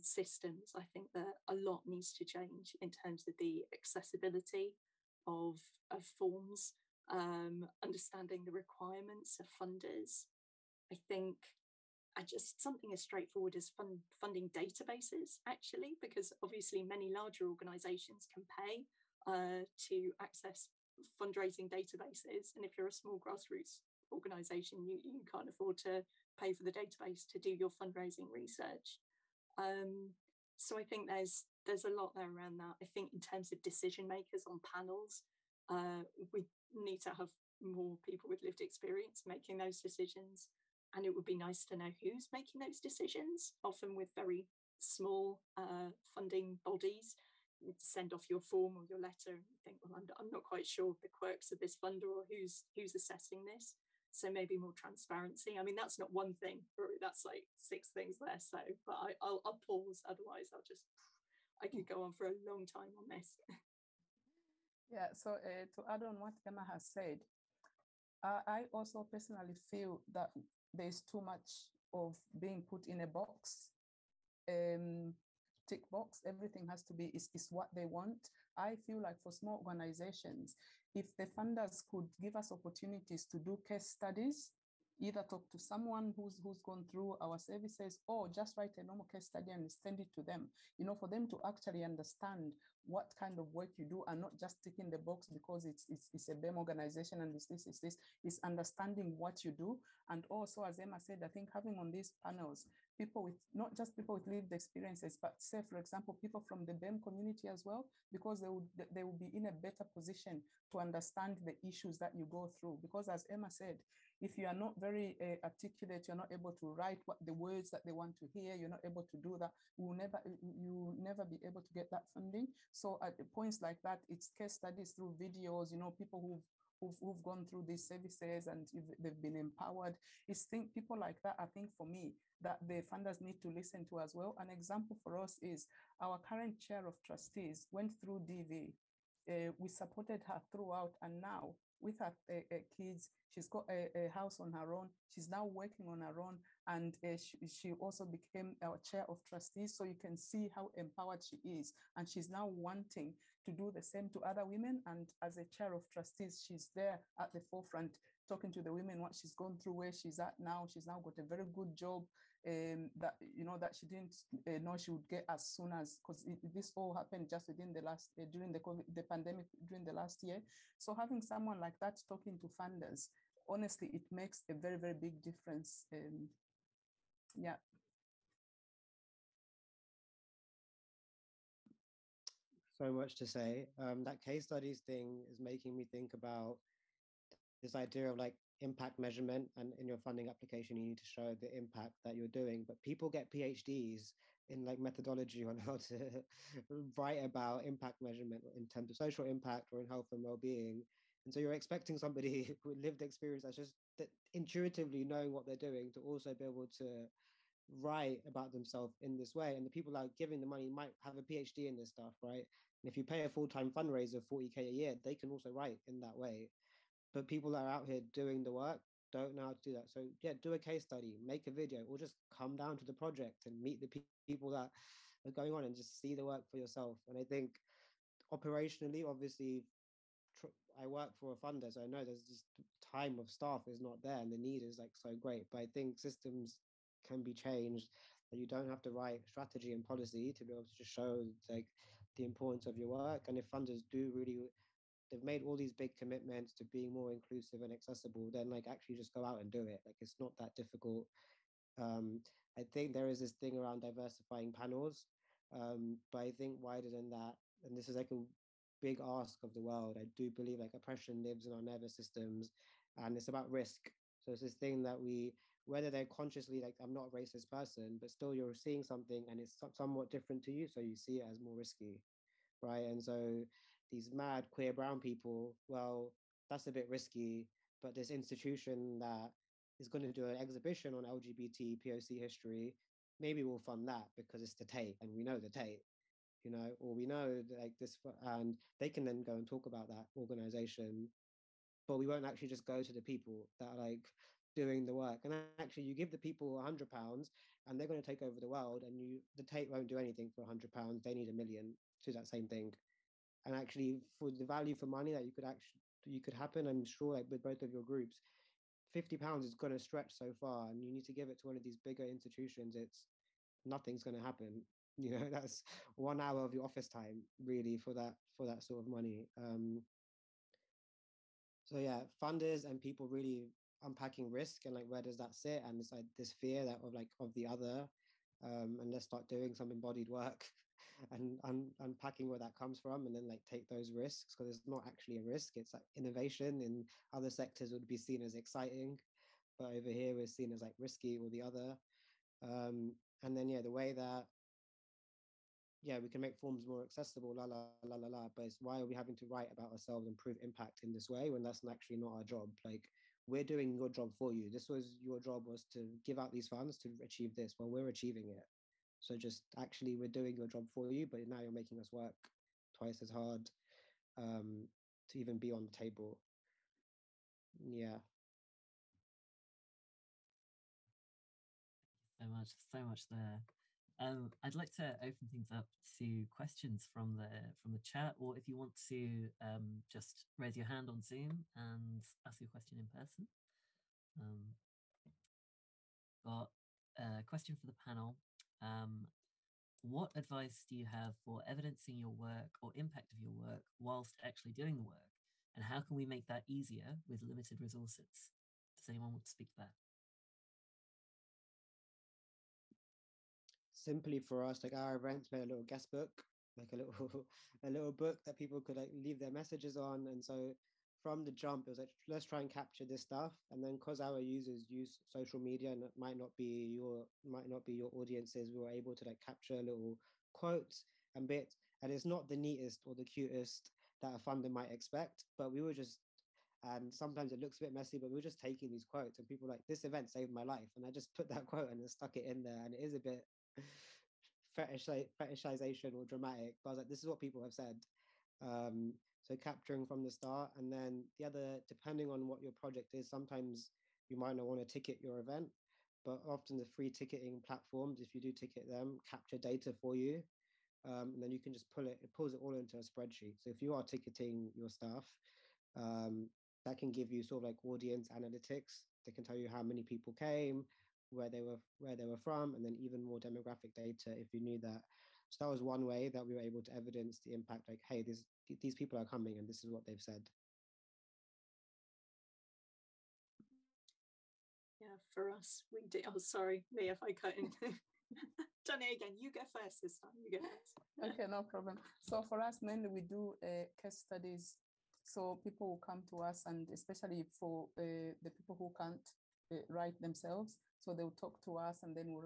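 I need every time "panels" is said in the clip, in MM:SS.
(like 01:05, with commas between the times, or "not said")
00:34, 01:42, 04:14, 06:27.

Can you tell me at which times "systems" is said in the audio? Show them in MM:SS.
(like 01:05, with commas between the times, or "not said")
00:00, 03:55, 04:21.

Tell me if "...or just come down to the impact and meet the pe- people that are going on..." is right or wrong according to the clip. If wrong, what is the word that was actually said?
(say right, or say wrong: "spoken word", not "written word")
wrong: "project", not "impact".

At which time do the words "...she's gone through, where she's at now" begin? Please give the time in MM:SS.
02:39.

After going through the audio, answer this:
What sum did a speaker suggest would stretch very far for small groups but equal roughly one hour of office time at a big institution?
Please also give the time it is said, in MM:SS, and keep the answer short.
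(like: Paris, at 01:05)
£50, at 05:08.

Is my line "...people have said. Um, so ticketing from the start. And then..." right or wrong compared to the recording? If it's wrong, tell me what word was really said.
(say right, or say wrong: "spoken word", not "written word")
wrong: "capturing", not "ticketing".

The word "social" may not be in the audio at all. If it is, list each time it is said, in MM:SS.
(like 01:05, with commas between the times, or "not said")
03:18, 06:55.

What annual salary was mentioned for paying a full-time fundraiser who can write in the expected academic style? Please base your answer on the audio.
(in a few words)
£40K.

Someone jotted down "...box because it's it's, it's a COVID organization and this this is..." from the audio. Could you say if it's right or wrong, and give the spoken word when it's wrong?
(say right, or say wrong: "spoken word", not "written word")
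wrong: "BEM", not "COVID".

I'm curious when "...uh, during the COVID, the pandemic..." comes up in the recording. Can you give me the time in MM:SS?
02:48.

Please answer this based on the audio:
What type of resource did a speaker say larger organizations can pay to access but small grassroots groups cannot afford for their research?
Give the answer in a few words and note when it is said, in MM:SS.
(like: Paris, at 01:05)
Fundraising databases, at 00:21.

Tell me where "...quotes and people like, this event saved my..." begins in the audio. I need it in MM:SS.
07:08.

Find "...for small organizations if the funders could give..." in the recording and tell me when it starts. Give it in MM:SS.
01:19.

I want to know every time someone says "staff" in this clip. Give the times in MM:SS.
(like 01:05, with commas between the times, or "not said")
03:53, 07:34.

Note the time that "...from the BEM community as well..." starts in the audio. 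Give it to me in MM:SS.
01:46.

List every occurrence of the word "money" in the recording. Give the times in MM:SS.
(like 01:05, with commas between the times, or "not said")
03:30, 05:04, 05:18.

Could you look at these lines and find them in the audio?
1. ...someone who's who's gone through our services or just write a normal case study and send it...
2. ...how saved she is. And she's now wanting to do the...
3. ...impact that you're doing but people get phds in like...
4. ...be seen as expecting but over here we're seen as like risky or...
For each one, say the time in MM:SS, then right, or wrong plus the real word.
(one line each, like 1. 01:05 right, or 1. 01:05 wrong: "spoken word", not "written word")
1. 01:25 right
2. 02:30 wrong: "empowered", not "saved"
3. 03:11 right
4. 05:37 wrong: "exciting", not "expecting".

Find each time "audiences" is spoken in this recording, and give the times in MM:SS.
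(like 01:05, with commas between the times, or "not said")
06:57, 07:37.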